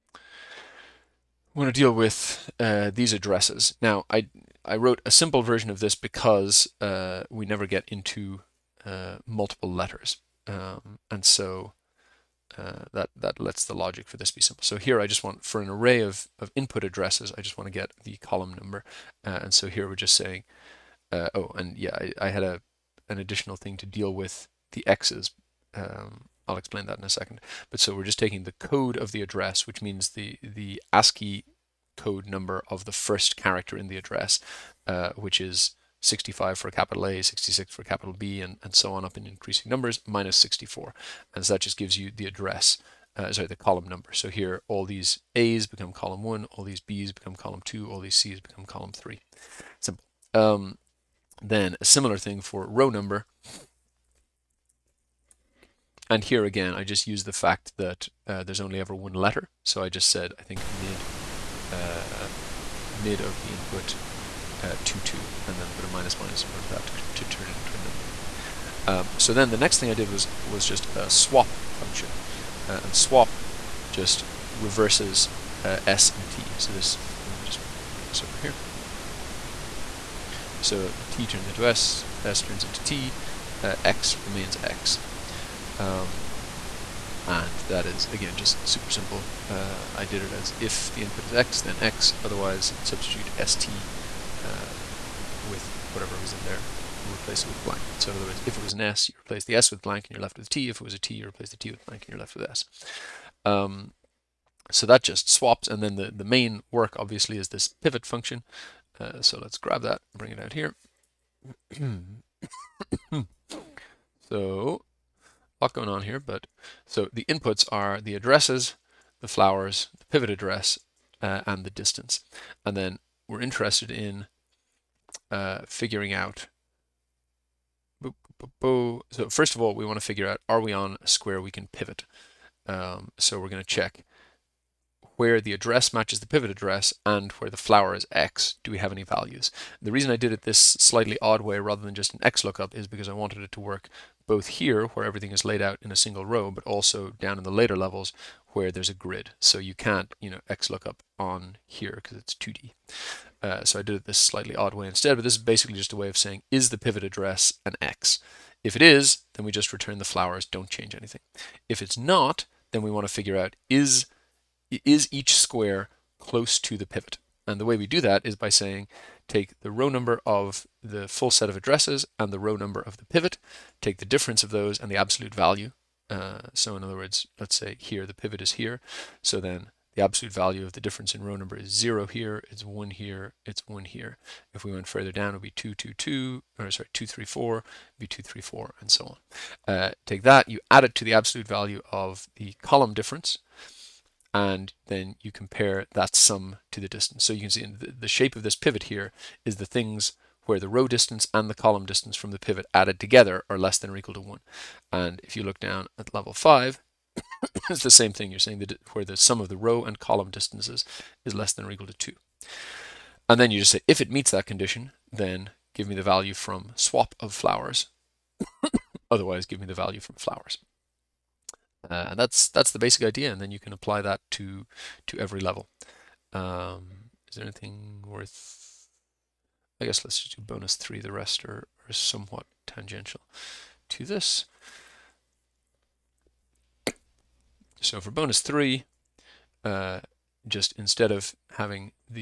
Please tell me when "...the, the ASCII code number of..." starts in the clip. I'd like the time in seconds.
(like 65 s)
30 s.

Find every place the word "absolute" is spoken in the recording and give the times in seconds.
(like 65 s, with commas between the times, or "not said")
174 s, 180 s, 191 s.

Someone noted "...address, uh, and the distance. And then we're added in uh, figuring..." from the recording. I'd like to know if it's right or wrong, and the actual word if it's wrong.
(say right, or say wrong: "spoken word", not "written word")
wrong: "interested", not "added".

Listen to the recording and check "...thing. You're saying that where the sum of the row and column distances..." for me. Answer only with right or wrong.
right.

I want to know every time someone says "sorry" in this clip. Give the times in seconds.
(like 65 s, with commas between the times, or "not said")
43 s, 186 s.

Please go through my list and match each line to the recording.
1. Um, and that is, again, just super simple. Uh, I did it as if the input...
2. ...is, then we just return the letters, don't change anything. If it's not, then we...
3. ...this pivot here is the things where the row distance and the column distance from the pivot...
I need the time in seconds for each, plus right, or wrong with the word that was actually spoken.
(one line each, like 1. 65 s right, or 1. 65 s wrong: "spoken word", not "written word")
1. 85 s right
2. 158 s wrong: "flowers", not "letters"
3. 198 s right.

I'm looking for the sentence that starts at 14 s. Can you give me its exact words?
So here I just want, for an array of, of input addresses, I just want to get the column number.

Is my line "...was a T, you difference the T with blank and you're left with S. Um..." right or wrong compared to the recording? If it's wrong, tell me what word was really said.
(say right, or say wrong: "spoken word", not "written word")
wrong: "replace", not "difference".